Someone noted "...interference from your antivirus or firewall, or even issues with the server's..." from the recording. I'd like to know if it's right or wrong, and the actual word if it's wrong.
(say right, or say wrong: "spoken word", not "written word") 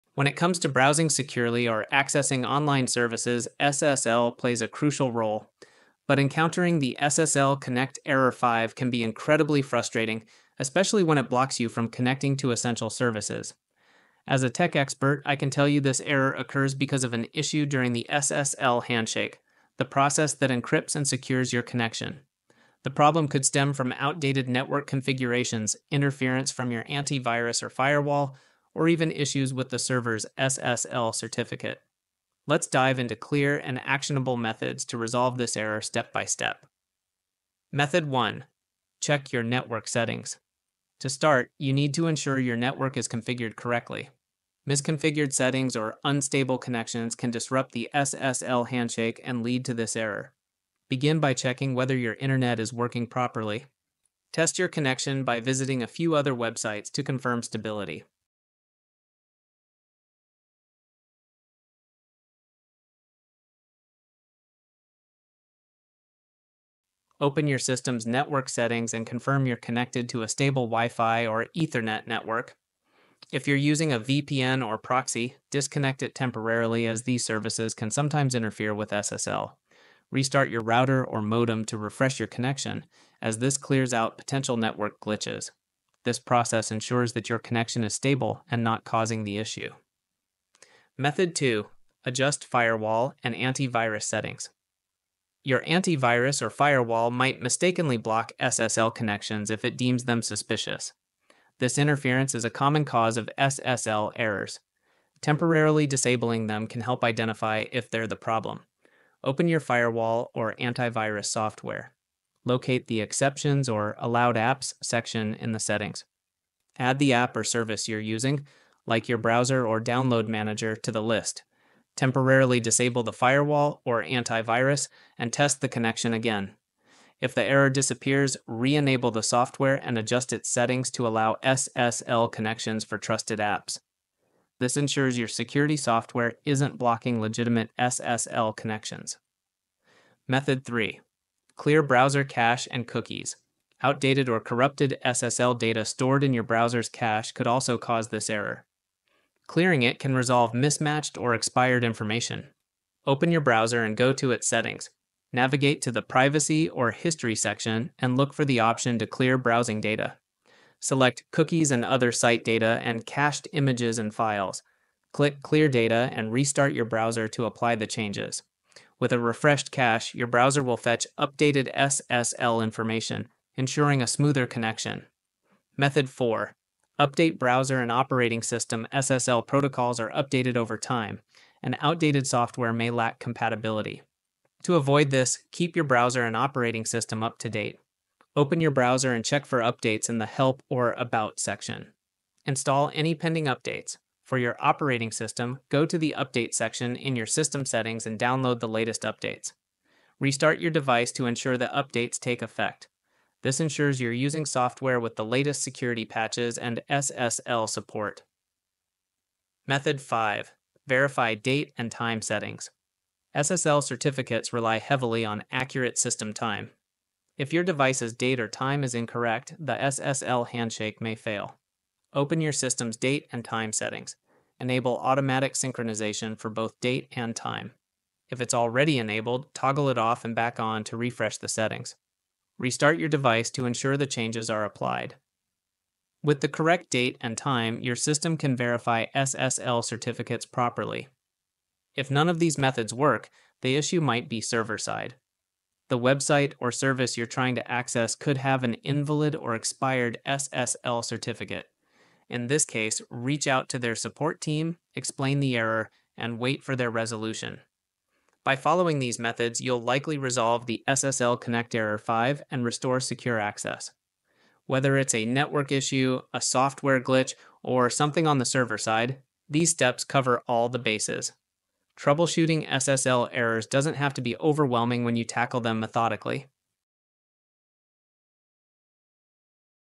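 right.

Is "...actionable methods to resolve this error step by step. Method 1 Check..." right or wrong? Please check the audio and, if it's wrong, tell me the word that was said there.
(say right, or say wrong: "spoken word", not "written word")
right.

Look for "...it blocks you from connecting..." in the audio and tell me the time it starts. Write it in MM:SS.
00:11.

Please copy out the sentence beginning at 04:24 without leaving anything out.
Whether it's a network issue, a software glitch, or something on the server side, these steps cover all the bases.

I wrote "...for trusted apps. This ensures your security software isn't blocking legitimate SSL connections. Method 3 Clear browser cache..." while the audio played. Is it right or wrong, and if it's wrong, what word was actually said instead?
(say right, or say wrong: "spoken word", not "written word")
right.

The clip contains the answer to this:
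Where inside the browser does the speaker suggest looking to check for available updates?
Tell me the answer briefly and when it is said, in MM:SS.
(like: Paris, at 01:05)
Help or About section, at 03:10.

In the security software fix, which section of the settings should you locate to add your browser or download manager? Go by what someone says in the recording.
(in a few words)
Exceptions or Allowed Apps.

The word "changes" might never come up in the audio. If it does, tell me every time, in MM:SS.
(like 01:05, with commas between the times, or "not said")
02:47, 03:54.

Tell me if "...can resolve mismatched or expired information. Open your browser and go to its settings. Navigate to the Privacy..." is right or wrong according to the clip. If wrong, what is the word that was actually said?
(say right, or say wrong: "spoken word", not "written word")
right.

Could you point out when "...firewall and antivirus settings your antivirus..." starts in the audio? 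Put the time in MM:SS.
01:32.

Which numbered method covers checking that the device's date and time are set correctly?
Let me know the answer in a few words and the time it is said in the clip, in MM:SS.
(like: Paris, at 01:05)
5, at 03:29.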